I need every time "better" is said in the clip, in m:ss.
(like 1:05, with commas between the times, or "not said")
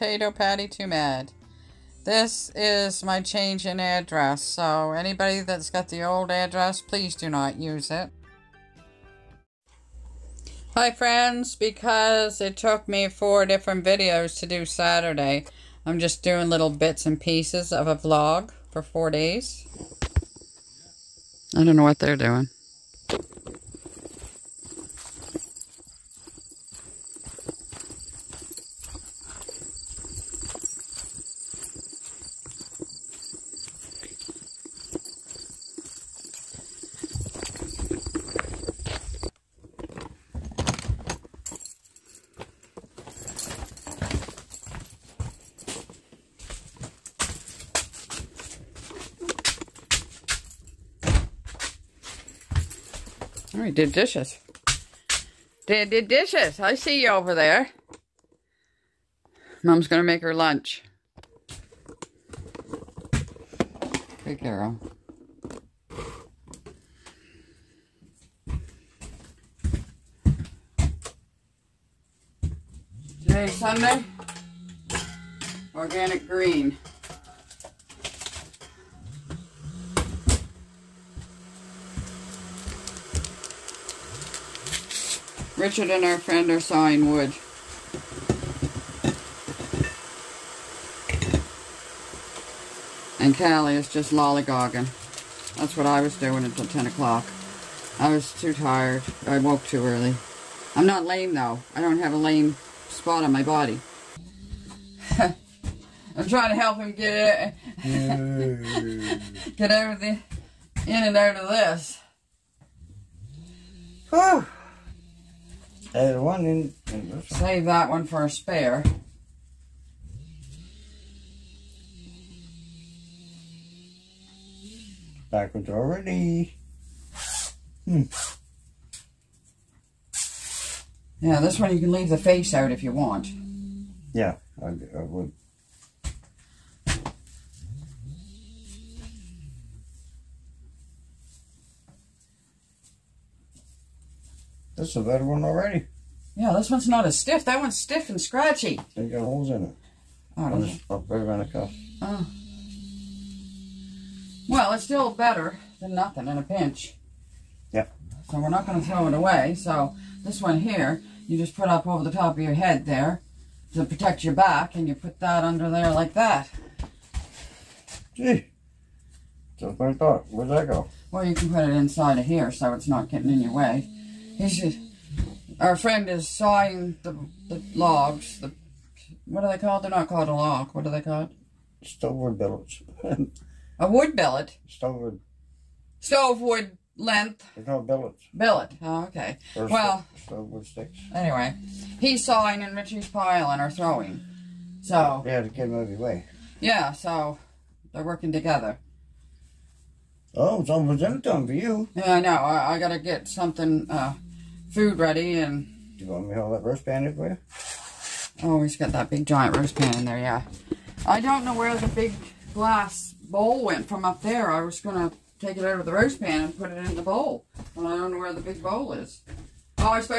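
2:25, 2:35.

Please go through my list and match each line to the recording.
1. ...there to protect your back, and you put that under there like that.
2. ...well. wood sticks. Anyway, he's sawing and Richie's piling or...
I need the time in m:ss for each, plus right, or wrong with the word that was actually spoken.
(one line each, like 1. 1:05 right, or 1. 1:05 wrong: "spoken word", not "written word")
1. 2:42 right
2. 3:09 right.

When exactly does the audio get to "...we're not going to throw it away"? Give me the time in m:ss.
2:38.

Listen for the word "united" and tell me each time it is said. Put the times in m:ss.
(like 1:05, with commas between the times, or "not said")
not said.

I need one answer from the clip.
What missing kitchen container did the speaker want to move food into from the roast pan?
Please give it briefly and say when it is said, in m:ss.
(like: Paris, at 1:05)
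big glass bowl, at 3:31.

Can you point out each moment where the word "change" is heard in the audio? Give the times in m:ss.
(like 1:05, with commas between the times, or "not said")
0:03.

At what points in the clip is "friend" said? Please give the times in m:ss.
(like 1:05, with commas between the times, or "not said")
0:10, 1:26, 2:55.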